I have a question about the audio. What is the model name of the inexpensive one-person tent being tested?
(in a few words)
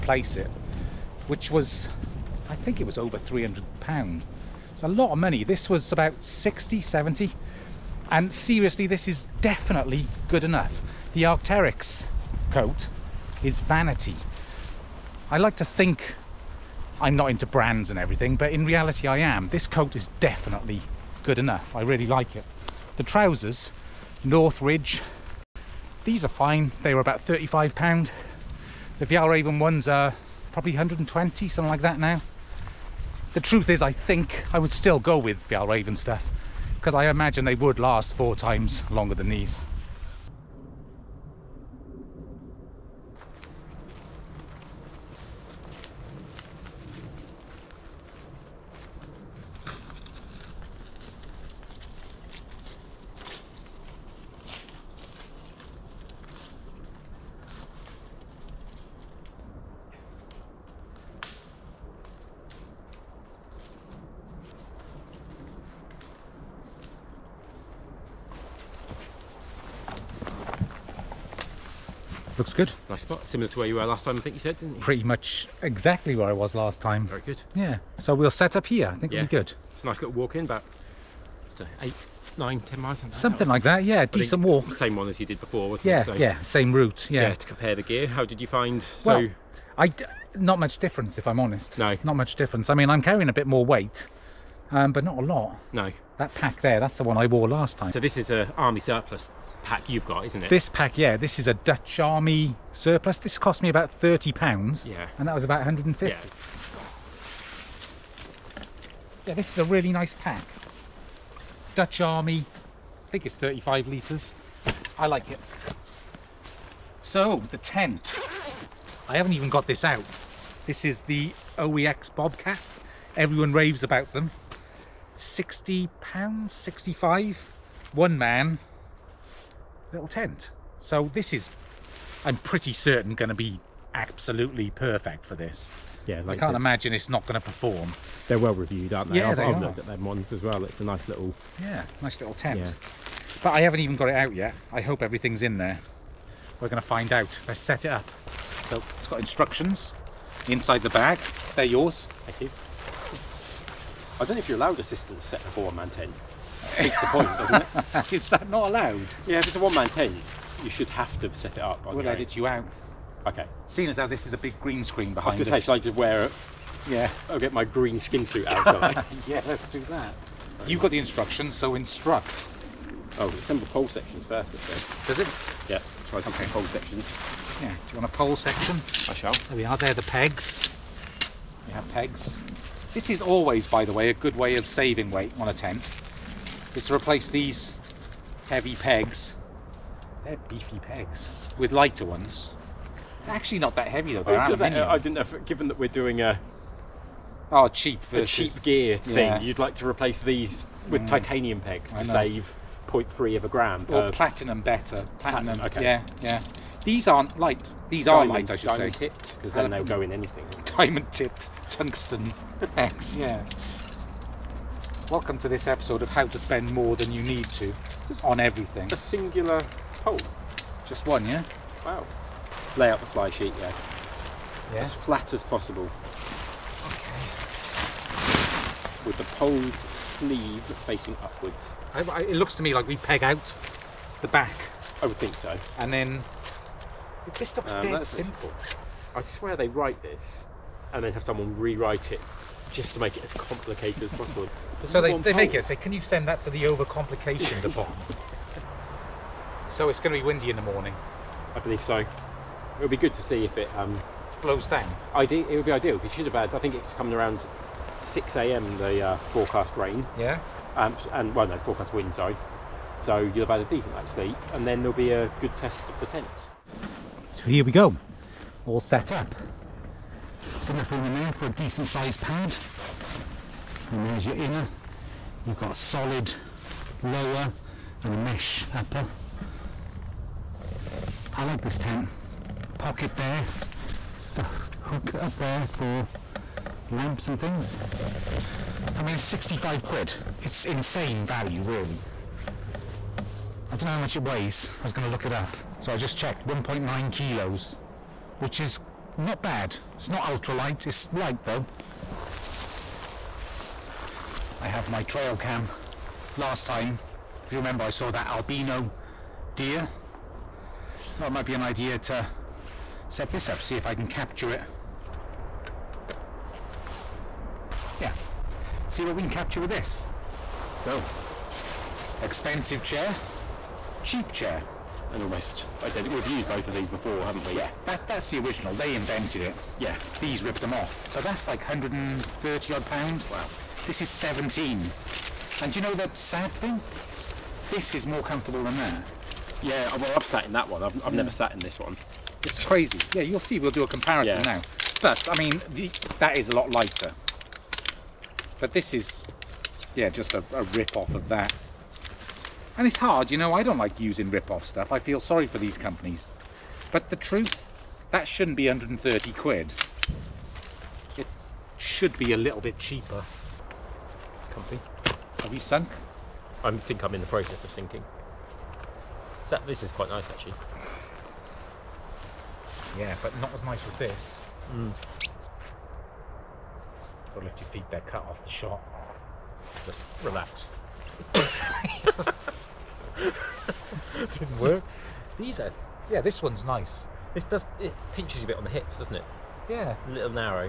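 OEX Bobcat.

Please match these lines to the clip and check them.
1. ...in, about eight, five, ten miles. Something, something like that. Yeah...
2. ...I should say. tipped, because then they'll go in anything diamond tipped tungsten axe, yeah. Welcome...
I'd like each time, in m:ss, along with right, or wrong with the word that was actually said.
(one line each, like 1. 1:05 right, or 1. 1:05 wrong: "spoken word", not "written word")
1. 1:20 wrong: "nine", not "five"
2. 3:28 right.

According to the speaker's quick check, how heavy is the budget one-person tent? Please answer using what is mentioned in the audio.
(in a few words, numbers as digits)
1.9 kilos.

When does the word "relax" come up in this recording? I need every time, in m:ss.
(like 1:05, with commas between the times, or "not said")
6:20.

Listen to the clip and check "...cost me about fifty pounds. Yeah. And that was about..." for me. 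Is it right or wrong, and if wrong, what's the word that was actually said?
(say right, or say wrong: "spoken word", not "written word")
wrong: "thirty", not "fifty".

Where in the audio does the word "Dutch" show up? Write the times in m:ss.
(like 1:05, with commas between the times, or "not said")
1:41, 1:51.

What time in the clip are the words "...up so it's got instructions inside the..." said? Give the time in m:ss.
2:27.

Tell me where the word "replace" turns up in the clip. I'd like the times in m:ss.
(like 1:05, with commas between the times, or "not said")
3:06, 3:19.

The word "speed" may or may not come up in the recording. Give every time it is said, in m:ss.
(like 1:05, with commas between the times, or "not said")
not said.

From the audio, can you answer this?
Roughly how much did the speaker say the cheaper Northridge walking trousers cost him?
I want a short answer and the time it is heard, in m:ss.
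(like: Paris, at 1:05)
£35, at 0:26.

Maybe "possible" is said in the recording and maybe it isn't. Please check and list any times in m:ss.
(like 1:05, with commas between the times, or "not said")
3:45, 4:04.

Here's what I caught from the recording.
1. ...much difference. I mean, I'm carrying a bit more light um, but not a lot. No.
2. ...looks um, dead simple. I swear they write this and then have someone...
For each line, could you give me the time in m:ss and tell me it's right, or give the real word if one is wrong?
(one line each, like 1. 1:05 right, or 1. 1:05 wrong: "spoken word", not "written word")
1. 1:32 wrong: "weight", not "light"
2. 3:57 right.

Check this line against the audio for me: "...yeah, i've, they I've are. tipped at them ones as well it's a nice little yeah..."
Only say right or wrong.
wrong.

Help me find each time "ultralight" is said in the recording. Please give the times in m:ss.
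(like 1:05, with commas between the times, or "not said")
5:00.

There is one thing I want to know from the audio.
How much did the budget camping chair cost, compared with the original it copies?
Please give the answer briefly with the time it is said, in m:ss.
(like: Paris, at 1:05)
17, at 5:33.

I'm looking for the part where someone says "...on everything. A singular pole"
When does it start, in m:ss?
3:38.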